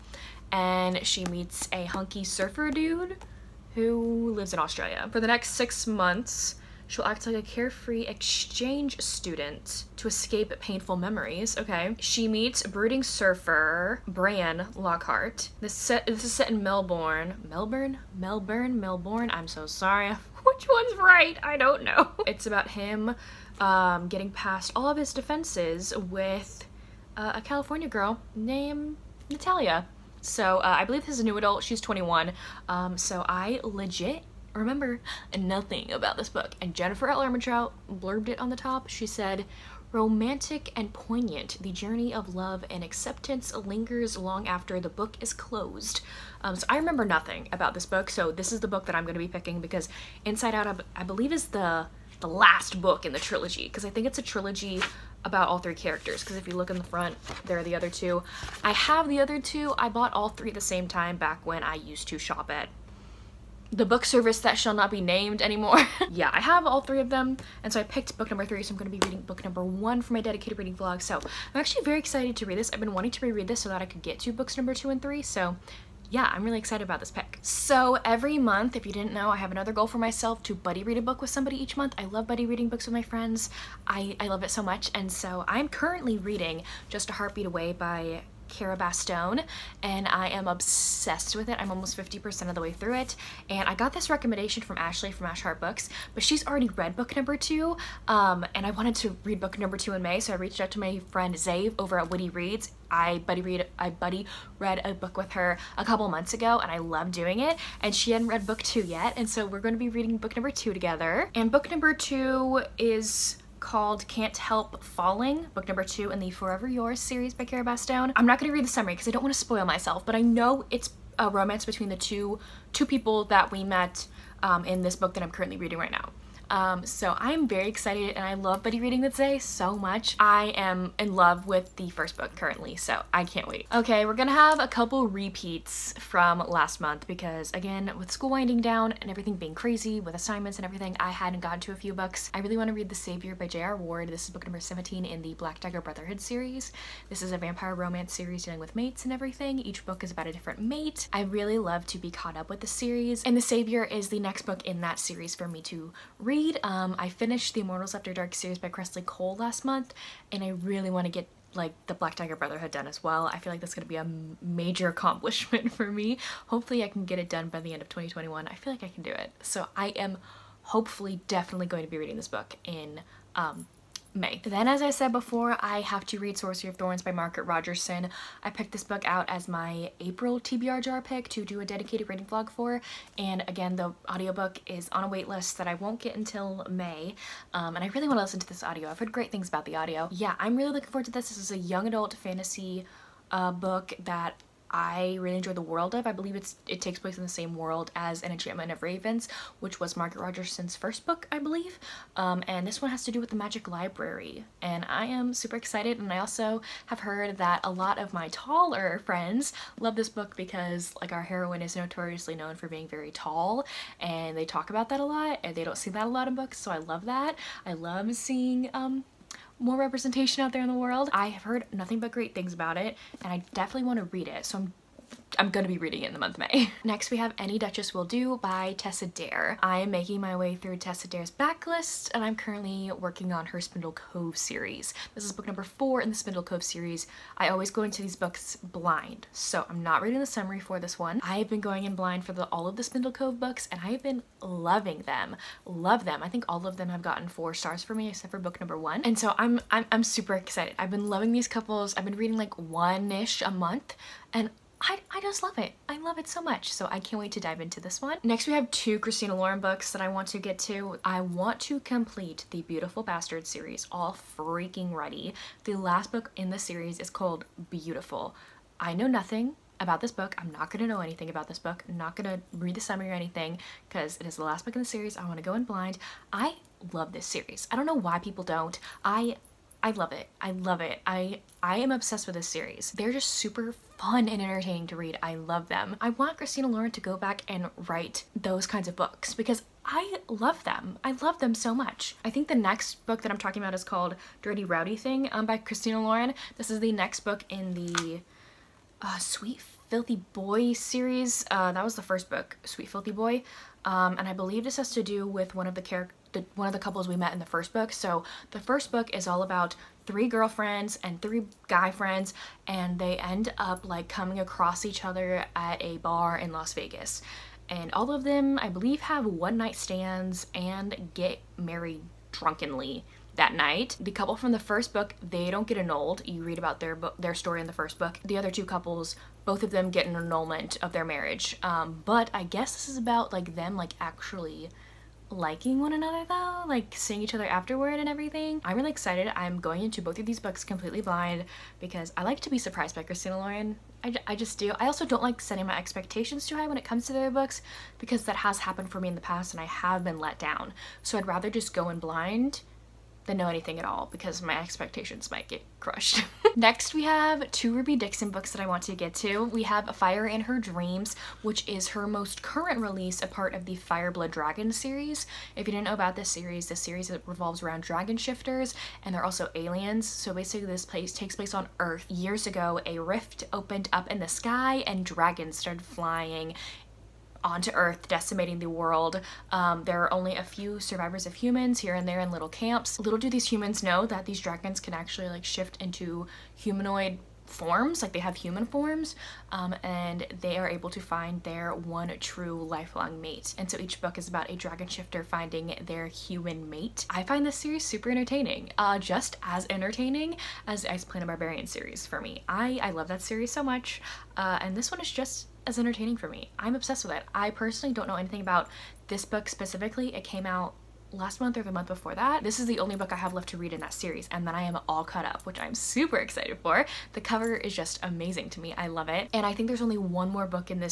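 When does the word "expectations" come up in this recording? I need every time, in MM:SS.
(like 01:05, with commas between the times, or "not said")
05:45, 05:54.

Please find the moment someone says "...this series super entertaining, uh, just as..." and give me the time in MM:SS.
06:37.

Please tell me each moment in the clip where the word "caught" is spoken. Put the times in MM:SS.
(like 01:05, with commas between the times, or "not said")
02:32, 06:55.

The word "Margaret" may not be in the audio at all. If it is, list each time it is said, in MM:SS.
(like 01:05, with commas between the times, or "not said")
02:57, 03:19.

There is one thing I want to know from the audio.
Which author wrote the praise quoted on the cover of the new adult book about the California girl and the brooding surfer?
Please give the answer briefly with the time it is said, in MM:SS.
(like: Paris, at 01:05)
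Jennifer Armentrout, at 00:36.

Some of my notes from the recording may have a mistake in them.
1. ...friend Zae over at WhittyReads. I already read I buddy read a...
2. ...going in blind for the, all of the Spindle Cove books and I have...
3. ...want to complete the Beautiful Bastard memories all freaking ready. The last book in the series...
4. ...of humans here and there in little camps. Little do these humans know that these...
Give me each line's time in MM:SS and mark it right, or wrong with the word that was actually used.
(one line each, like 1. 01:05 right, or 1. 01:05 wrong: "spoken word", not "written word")
1. 01:41 wrong: "buddy", not "already"
2. 04:01 right
3. 04:21 wrong: "series", not "memories"
4. 06:21 right.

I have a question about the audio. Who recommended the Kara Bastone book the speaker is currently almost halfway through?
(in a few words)
Ashley.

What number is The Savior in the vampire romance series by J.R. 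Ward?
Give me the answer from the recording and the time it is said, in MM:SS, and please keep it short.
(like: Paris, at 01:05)
17, at 02:24.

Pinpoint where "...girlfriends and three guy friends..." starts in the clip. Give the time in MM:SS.
05:10.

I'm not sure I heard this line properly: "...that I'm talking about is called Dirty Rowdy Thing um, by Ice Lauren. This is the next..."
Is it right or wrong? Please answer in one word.
wrong.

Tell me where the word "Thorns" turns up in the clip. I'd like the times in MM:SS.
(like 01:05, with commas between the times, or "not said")
02:56.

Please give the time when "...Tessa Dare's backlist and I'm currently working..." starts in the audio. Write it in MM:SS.
03:50.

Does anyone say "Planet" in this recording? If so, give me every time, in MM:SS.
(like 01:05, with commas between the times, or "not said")
06:41.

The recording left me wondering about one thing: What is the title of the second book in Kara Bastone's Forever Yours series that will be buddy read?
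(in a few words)
Can't Help Falling.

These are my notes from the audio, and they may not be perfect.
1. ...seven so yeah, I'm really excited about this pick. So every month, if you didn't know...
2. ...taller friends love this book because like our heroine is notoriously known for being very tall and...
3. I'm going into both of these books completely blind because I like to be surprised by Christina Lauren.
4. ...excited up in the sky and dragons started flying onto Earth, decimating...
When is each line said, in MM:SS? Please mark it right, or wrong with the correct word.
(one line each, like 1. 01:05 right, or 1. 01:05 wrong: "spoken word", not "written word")
1. 01:15 wrong: "three", not "seven"
2. 03:28 right
3. 05:39 right
4. 06:13 wrong: "opened", not "excited".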